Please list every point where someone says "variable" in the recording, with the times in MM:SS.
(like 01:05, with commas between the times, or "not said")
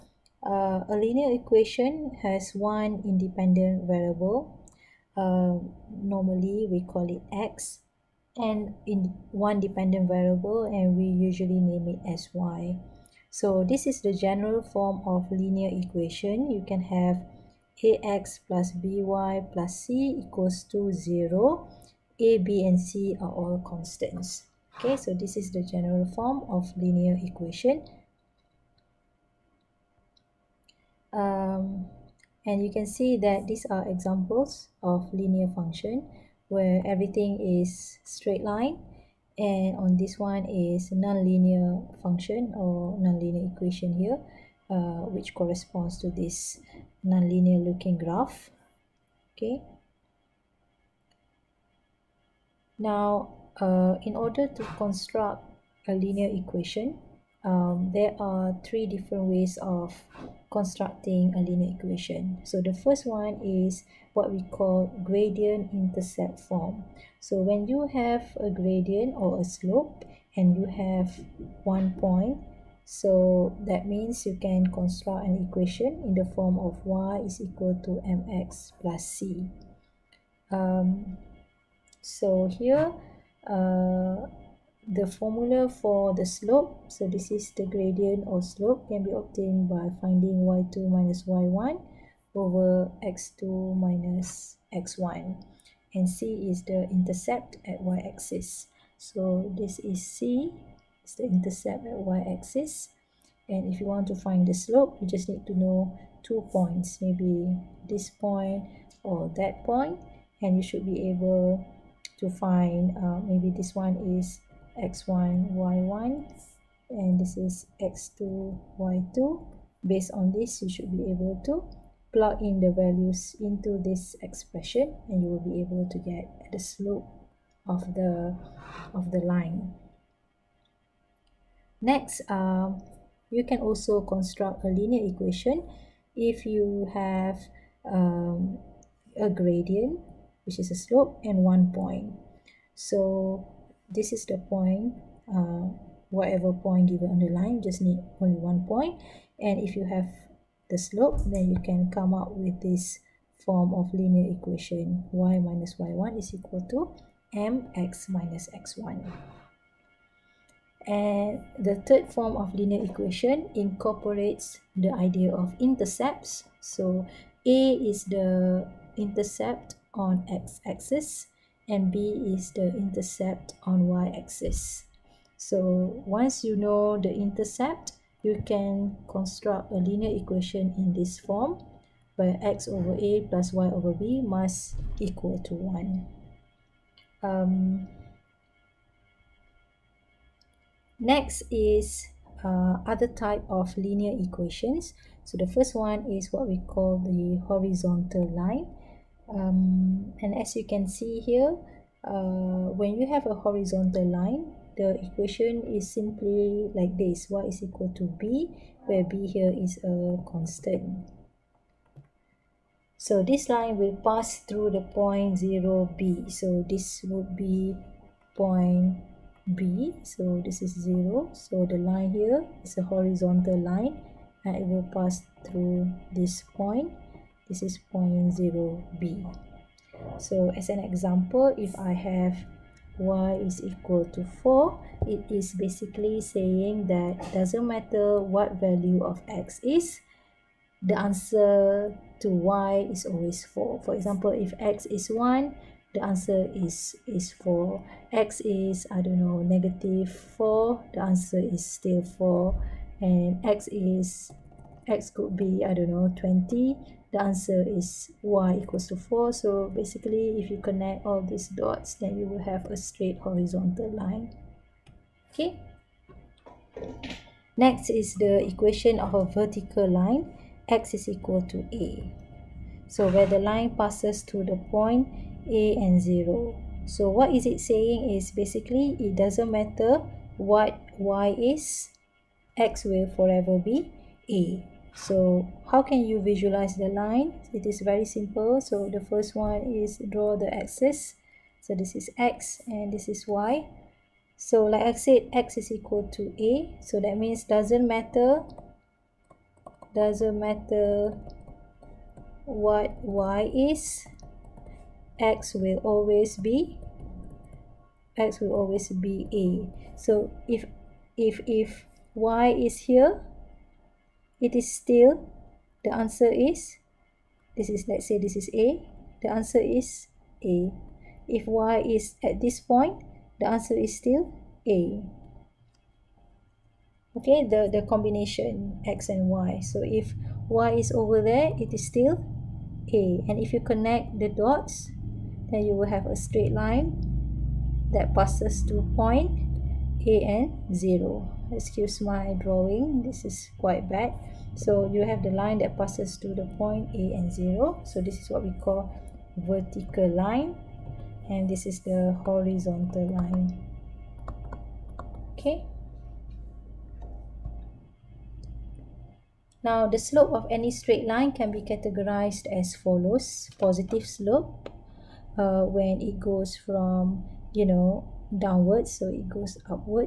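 00:03, 00:10.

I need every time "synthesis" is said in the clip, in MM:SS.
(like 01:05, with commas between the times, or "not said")
not said.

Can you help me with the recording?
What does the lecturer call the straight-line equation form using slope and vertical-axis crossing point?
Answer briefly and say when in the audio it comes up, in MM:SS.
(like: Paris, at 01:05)
gradient intercept form, at 01:05.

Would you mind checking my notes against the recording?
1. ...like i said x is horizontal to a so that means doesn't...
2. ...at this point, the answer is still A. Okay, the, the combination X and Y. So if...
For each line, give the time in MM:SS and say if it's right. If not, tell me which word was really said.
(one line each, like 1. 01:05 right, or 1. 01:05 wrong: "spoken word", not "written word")
1. 04:54 wrong: "equal", not "horizontal"
2. 05:22 right.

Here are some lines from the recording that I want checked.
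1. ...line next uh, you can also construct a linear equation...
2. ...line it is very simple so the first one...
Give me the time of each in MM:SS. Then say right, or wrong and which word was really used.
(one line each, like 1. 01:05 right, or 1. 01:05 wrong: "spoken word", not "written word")
1. 02:09 right
2. 04:46 right.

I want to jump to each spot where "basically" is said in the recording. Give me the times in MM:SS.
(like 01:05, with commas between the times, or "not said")
03:55, 04:19, 04:38.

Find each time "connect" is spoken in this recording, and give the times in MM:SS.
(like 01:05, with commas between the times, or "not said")
04:20, 05:33.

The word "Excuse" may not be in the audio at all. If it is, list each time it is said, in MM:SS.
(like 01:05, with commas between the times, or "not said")
05:41.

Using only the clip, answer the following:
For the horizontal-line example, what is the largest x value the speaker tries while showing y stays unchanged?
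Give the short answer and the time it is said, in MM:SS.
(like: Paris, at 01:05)
20, at 04:16.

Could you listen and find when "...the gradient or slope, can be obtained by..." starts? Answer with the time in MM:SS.
01:27.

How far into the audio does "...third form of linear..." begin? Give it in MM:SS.
02:41.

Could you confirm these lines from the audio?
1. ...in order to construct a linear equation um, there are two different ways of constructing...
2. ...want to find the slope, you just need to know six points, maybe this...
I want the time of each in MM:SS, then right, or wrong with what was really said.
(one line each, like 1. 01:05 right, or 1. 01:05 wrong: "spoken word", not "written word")
1. 00:54 wrong: "three", not "two"
2. 01:43 wrong: "two", not "six".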